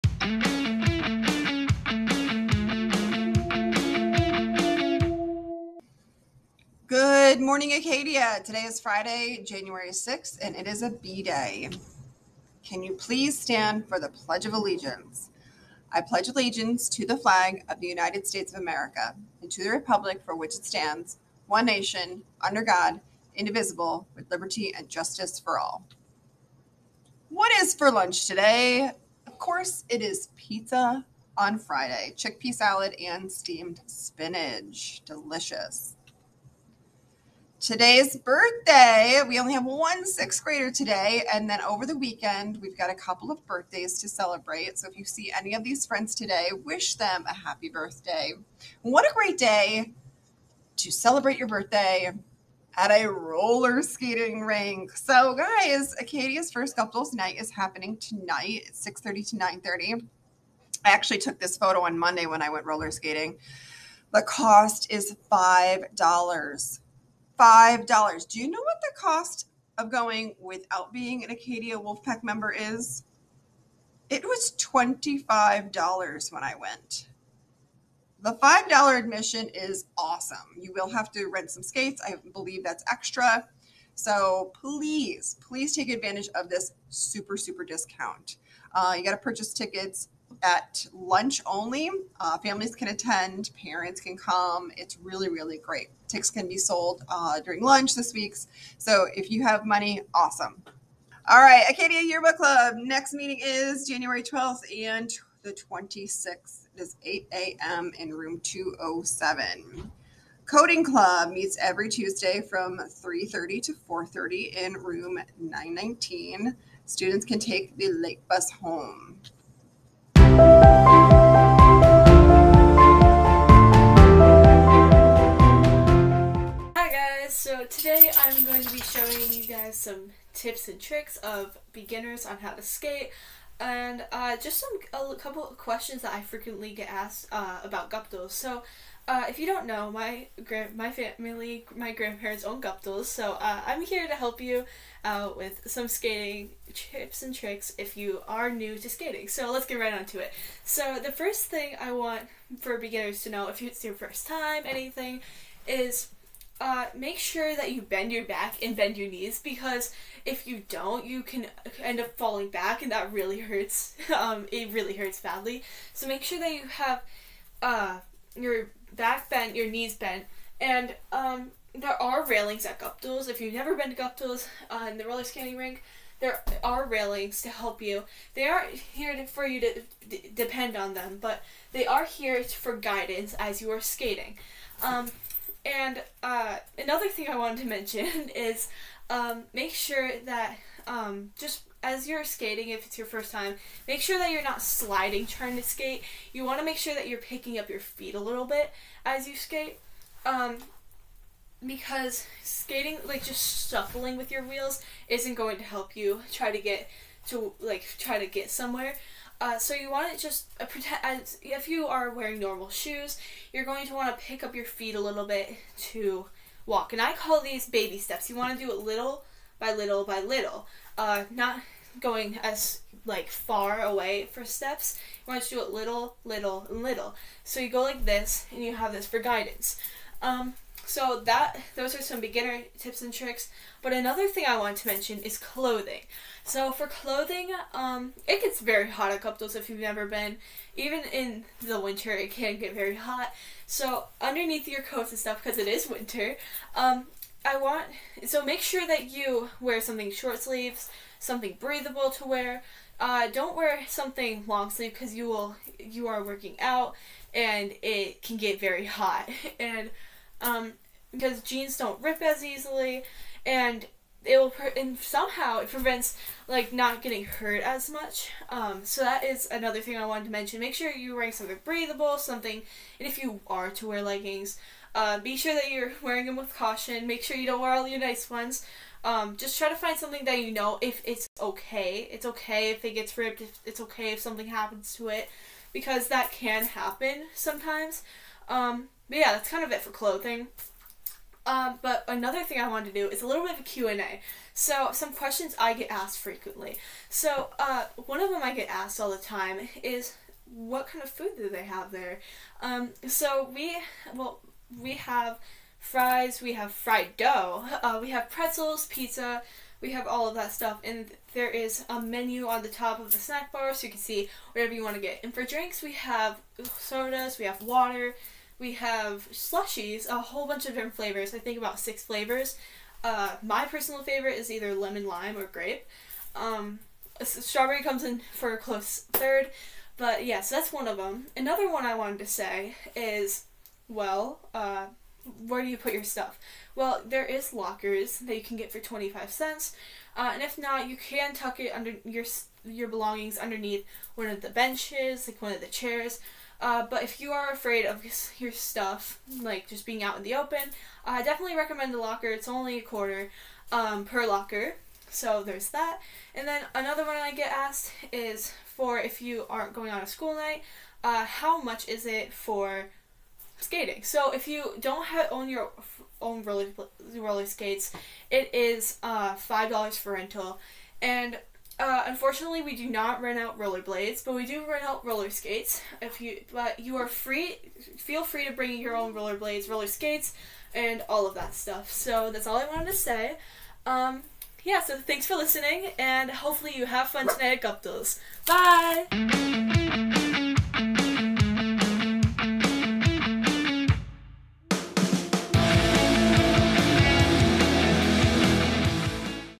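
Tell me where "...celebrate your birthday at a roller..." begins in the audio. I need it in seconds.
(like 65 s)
50 s.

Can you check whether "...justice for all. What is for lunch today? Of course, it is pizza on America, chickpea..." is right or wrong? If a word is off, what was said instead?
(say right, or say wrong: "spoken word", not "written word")
wrong: "Friday", not "America".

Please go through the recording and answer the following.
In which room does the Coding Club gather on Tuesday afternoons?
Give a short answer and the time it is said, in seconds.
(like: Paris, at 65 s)
Room 919, at 114 s.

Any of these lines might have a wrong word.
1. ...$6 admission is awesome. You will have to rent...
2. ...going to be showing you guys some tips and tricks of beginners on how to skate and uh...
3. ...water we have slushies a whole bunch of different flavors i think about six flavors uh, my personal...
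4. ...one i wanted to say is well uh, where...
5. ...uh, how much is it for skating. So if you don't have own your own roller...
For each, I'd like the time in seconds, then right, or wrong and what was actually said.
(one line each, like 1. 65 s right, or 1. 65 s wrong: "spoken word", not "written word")
1. 78 s wrong: "5", not "6"
2. 128 s right
3. 317 s right
4. 331 s right
5. 361 s right.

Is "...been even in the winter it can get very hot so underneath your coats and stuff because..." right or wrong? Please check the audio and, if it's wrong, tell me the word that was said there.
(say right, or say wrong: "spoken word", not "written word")
right.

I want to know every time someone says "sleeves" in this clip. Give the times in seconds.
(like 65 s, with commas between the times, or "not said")
250 s, 254 s.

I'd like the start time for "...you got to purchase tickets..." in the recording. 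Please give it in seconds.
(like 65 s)
88 s.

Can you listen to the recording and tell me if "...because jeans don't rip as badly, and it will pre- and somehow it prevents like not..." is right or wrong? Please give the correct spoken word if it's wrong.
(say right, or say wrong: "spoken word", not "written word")
wrong: "easily", not "badly".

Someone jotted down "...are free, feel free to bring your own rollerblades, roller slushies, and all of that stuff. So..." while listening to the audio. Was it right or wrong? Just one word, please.
wrong.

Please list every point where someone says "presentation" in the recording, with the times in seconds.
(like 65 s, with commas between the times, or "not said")
not said.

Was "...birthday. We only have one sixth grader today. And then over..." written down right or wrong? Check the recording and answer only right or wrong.
right.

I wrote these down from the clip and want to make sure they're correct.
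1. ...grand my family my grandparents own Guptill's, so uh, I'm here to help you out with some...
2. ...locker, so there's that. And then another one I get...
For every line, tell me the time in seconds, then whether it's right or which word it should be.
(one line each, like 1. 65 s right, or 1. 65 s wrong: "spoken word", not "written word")
1. 140 s right
2. 354 s right.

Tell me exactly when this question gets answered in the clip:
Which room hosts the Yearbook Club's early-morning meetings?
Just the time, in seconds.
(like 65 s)
108 s.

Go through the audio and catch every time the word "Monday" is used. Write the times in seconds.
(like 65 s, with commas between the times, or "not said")
61 s.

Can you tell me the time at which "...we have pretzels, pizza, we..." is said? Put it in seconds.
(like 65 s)
308 s.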